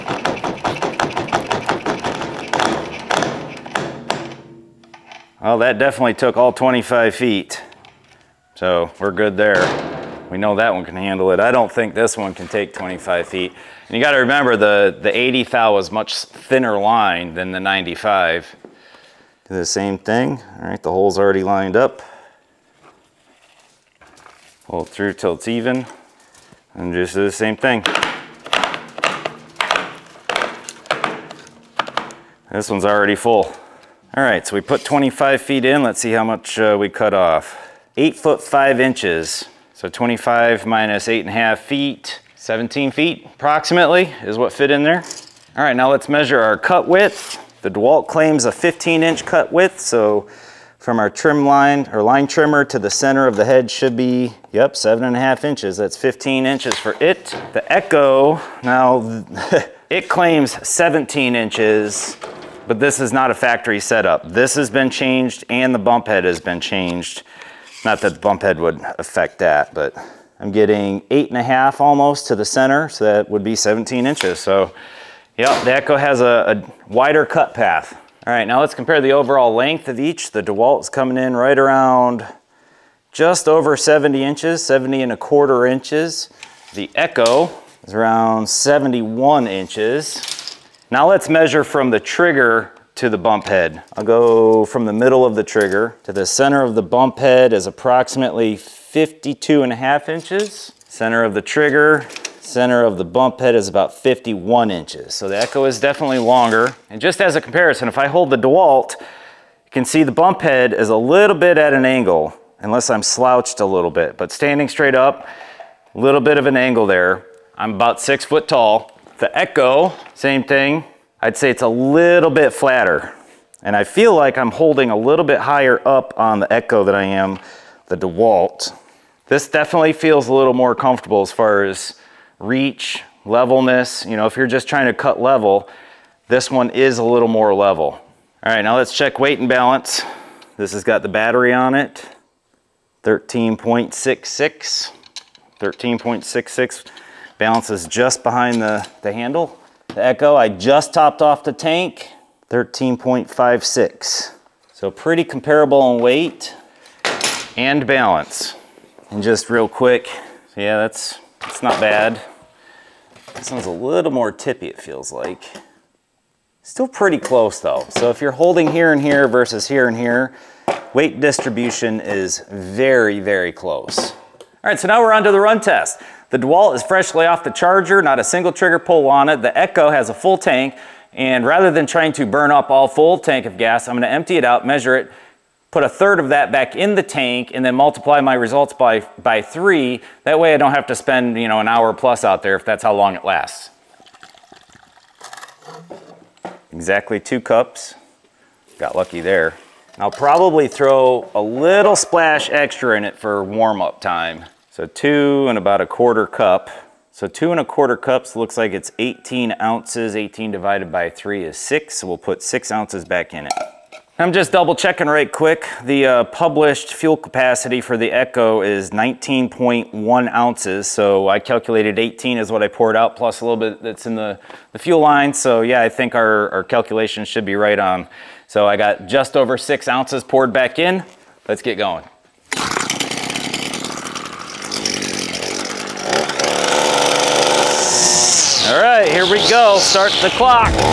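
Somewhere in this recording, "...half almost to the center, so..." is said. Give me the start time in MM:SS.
01:11.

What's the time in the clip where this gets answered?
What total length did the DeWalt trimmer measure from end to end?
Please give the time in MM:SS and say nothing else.
01:24.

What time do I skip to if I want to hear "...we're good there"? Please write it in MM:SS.
00:08.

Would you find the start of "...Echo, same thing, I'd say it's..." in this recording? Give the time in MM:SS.
01:59.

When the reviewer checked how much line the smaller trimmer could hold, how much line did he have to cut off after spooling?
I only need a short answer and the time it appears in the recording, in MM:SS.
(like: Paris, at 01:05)
8 feet 5 inches, at 00:37.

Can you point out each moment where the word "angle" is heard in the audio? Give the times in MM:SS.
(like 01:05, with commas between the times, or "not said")
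01:51, 01:56.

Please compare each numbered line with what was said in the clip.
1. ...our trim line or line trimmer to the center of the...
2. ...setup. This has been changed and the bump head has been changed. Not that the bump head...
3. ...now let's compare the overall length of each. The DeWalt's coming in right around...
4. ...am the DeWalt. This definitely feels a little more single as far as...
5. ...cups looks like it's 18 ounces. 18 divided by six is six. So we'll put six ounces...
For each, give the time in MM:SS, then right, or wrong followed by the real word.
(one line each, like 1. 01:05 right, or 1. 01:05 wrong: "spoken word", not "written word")
1. 00:50 right
2. 01:03 right
3. 01:18 right
4. 02:07 wrong: "comfortable", not "single"
5. 03:27 wrong: "three", not "six".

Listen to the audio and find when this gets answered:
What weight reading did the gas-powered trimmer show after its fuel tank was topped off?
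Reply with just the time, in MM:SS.
02:32.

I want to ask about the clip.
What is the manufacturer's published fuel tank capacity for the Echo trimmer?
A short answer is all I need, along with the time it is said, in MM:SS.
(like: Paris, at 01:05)
19.1 ounces, at 03:38.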